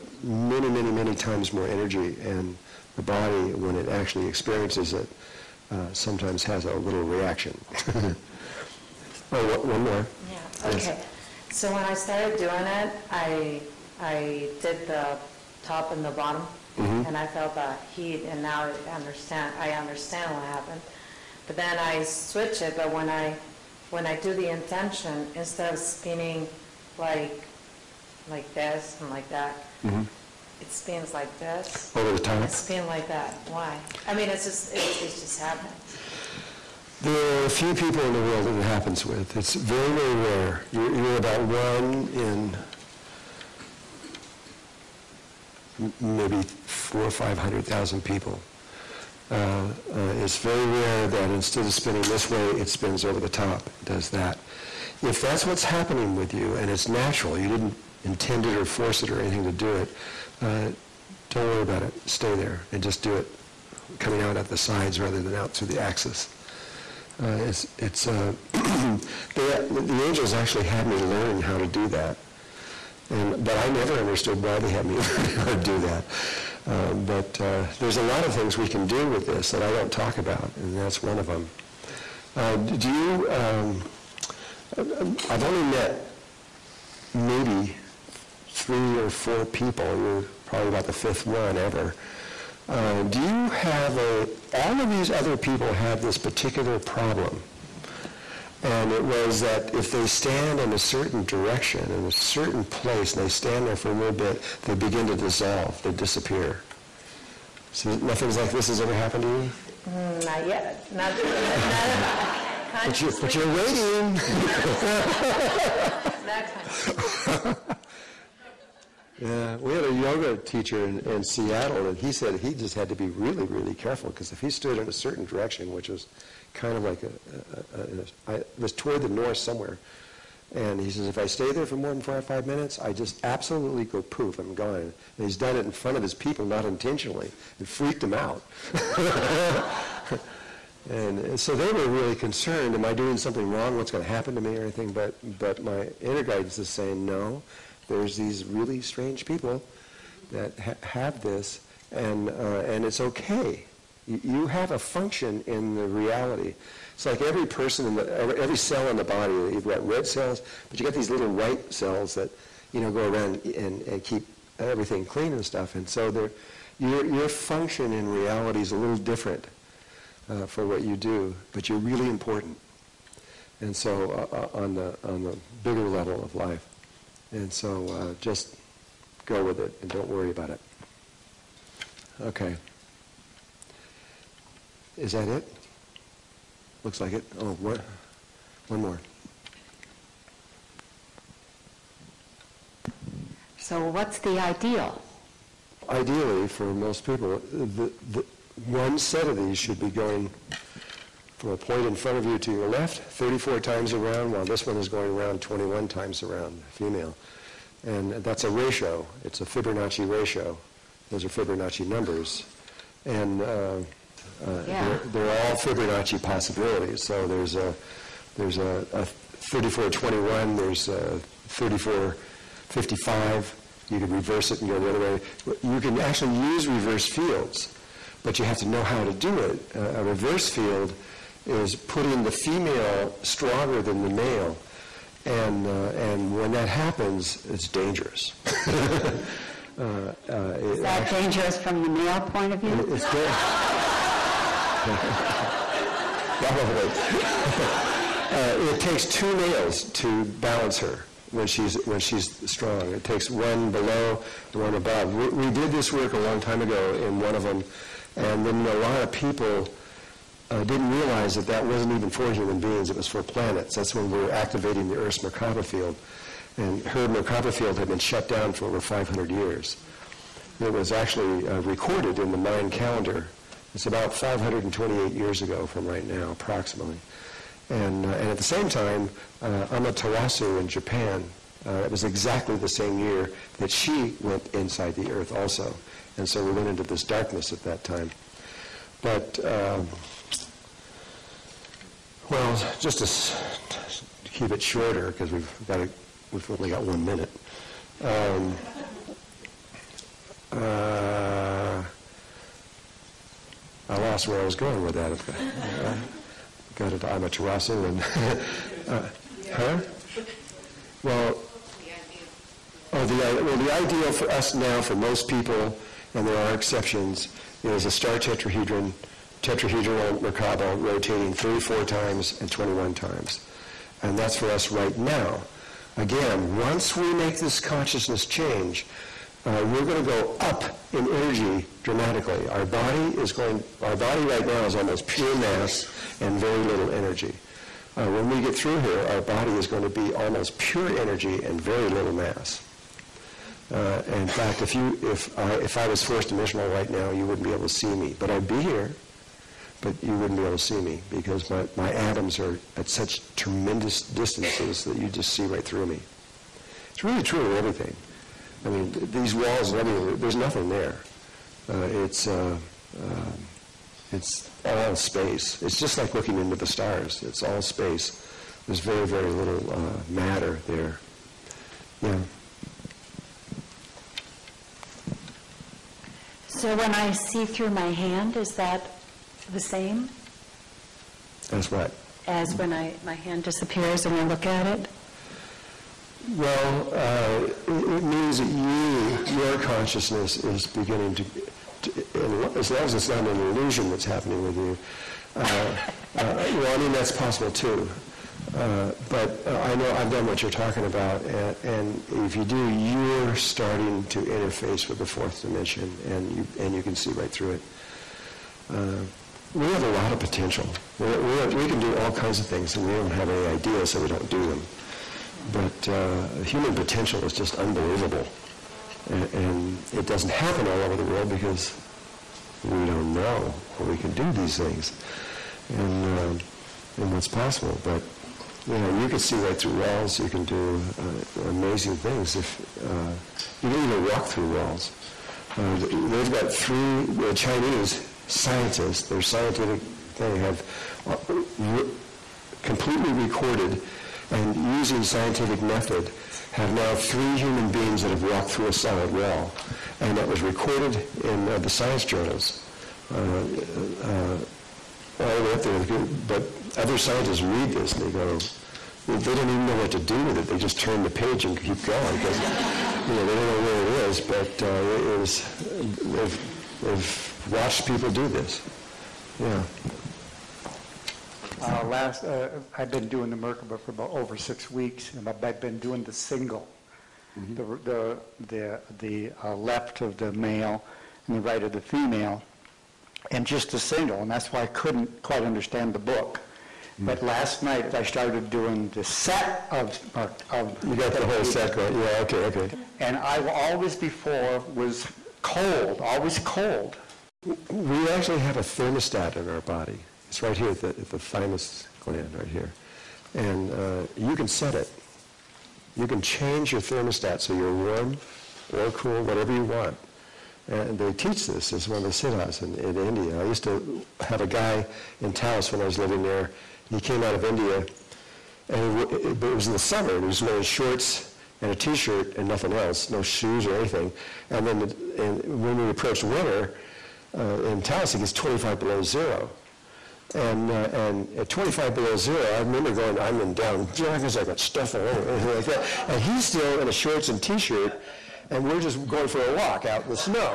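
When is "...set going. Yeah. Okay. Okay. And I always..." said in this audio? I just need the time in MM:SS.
08:11.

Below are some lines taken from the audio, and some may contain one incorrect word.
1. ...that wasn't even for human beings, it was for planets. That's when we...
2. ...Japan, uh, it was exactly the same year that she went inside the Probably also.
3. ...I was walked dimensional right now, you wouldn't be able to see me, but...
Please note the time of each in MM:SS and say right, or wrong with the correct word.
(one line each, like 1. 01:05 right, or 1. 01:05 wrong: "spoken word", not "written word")
1. 04:21 right
2. 04:40 wrong: "Earth", not "Probably"
3. 05:45 wrong: "forced", not "walked".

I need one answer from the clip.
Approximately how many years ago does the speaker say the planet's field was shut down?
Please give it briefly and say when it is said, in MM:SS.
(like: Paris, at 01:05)
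528, at 04:34.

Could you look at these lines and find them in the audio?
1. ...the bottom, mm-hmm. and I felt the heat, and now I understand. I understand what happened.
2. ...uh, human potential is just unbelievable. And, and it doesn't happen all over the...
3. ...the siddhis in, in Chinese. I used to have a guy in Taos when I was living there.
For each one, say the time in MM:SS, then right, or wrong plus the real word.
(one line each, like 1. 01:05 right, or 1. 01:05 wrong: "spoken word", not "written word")
1. 00:16 right
2. 06:55 right
3. 08:32 wrong: "India", not "Chinese".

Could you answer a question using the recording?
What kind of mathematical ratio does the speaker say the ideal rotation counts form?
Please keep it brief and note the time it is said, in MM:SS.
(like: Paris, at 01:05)
Fibonacci ratio, at 03:29.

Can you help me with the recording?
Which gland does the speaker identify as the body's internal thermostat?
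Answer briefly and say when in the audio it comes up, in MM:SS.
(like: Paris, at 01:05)
thymus gland, at 08:21.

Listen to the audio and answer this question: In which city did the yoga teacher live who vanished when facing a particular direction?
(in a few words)
Seattle.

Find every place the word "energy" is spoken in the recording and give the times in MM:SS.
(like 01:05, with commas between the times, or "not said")
00:01, 05:31, 05:36, 05:40.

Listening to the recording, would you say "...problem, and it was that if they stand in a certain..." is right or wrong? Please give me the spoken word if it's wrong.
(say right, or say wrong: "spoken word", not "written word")
right.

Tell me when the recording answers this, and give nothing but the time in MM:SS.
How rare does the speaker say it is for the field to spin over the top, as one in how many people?
00:46.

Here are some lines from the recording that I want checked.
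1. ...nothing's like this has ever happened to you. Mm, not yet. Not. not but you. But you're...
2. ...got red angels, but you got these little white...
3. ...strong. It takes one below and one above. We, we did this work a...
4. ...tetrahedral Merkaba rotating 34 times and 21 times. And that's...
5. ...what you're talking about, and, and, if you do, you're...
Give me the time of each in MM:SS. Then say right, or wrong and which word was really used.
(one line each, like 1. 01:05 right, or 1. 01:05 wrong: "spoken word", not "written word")
1. 01:48 right
2. 02:39 wrong: "cells", not "angels"
3. 04:12 right
4. 05:19 right
5. 06:40 right.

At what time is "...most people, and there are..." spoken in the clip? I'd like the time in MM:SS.
05:14.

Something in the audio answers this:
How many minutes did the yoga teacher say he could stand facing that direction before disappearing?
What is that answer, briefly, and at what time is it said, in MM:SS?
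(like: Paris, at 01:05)
4 or 5, at 02:12.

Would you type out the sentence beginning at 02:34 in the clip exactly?
You, you have a function in the reality.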